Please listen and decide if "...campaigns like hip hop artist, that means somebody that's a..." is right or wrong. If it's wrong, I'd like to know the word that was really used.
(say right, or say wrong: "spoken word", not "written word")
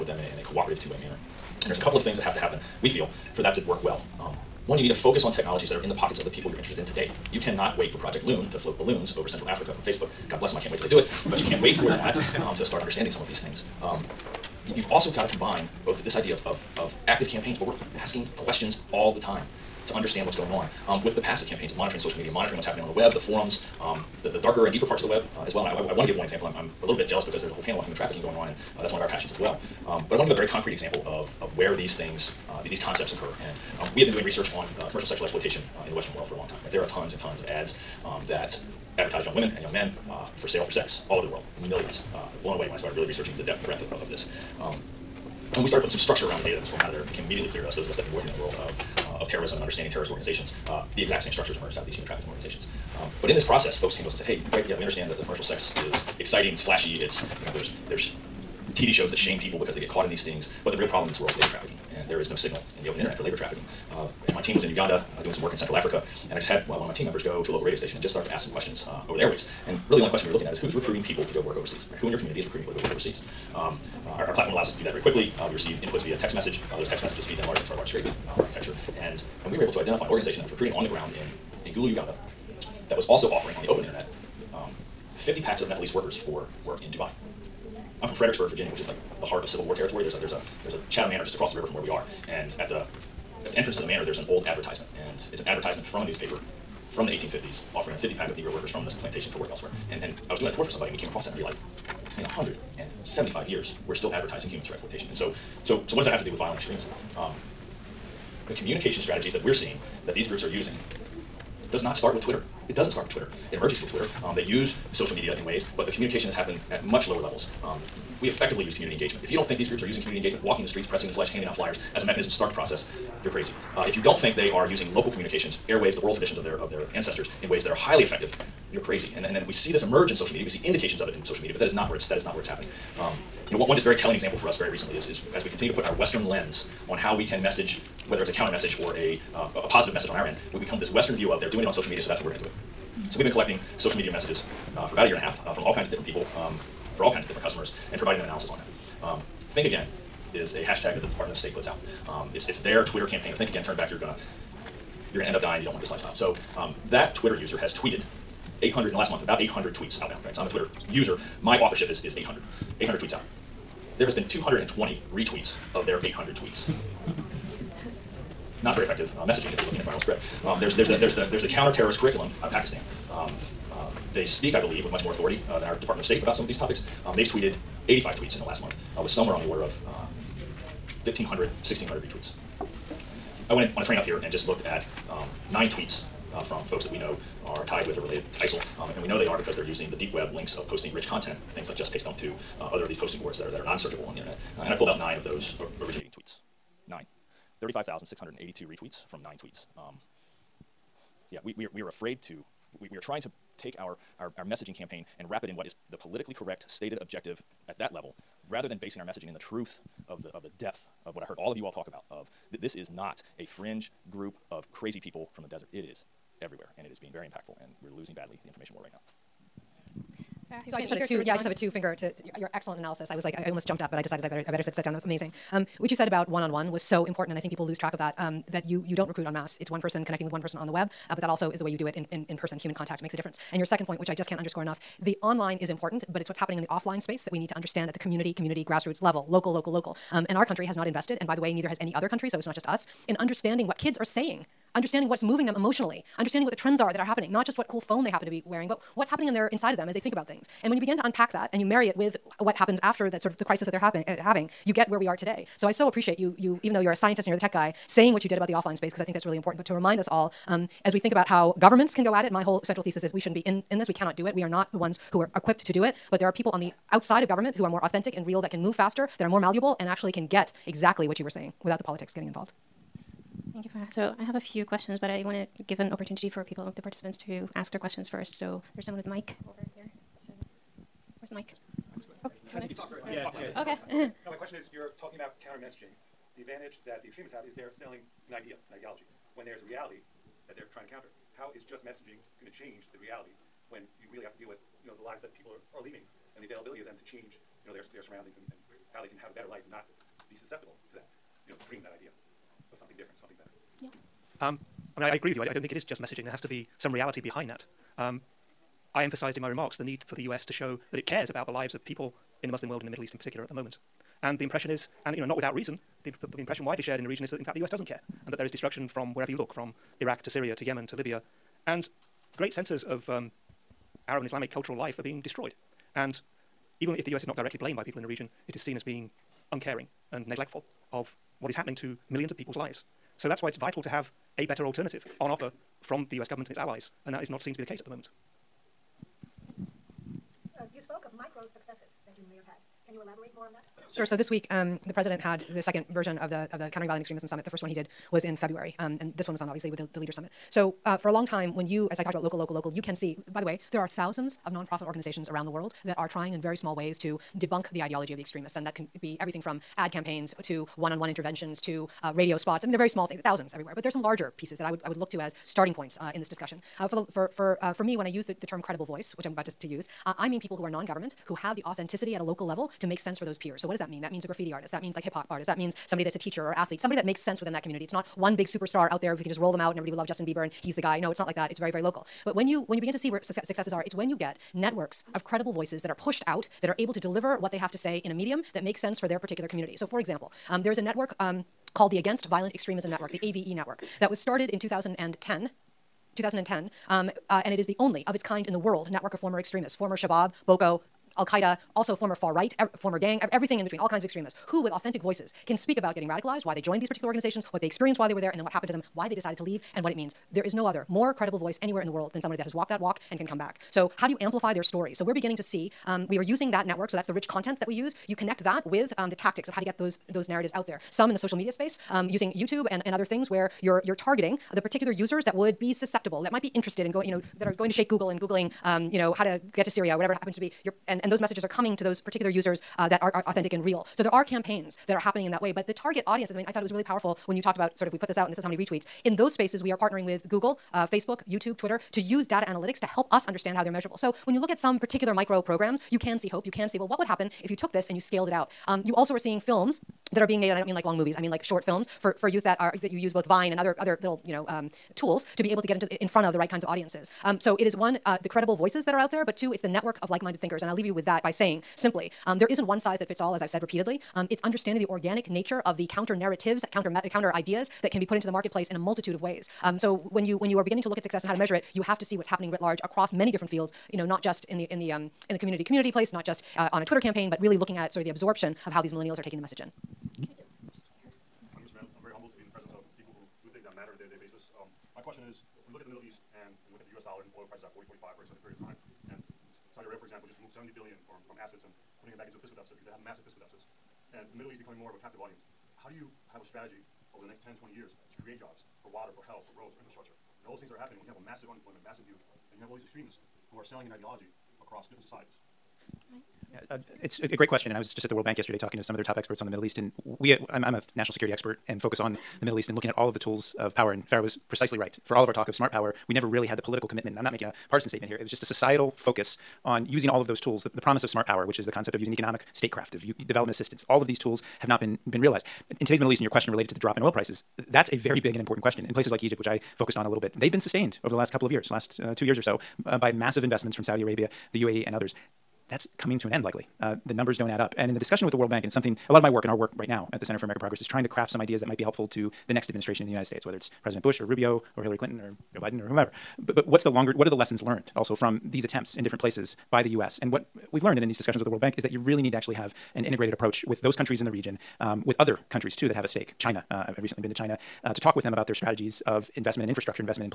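wrong: "means", not "campaigns".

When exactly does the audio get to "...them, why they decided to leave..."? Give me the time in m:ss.
6:48.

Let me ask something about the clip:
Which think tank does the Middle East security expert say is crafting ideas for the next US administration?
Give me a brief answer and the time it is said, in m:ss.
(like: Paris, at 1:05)
Center for American Progress, at 9:00.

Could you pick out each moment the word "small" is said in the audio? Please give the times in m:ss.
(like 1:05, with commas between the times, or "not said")
5:56, 6:02.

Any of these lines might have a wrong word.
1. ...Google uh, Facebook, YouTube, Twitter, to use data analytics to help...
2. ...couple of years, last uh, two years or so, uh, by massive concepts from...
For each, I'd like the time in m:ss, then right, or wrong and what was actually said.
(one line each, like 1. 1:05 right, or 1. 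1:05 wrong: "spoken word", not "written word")
1. 7:20 right
2. 8:51 wrong: "investments", not "concepts".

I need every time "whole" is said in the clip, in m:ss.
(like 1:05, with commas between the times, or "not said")
0:27, 4:22.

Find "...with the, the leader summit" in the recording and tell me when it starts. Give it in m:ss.
5:49.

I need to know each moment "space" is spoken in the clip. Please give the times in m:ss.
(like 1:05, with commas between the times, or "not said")
3:57, 4:18, 7:01, 7:19.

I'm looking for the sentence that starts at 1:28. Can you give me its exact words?
I'm from Fredericksburg, Virginia, which is like the heart of Civil War territory.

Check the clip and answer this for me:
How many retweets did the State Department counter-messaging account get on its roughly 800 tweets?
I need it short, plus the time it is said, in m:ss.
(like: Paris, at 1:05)
220, at 2:44.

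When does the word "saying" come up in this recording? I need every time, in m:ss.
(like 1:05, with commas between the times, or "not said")
4:04, 4:17, 4:31, 7:41.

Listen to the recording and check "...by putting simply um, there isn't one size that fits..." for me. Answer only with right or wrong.
wrong.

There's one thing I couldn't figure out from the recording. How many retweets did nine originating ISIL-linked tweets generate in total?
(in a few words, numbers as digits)
35,682.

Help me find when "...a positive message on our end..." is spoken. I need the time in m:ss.
2:19.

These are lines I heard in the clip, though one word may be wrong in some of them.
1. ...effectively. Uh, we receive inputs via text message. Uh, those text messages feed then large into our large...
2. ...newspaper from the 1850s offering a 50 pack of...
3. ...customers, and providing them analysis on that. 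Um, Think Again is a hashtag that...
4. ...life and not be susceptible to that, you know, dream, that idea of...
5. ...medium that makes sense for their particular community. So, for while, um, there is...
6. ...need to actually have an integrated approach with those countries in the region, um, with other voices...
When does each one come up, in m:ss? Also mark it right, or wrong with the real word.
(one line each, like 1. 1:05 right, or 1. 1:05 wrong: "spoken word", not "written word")
1. 1:14 wrong: "quickly", not "effectively"
2. 1:36 right
3. 2:27 right
4. 4:59 right
5. 6:28 wrong: "example", not "while"
6. 9:12 wrong: "countries", not "voices".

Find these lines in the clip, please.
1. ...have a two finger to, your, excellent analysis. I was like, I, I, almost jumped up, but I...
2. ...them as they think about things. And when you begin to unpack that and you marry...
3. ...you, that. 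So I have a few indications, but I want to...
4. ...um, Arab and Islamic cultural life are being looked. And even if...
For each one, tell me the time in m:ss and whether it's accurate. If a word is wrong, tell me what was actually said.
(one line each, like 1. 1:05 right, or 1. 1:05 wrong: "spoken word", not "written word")
1. 3:41 right
2. 4:09 right
3. 4:33 wrong: "questions", not "indications"
4. 5:23 wrong: "destroyed", not "looked".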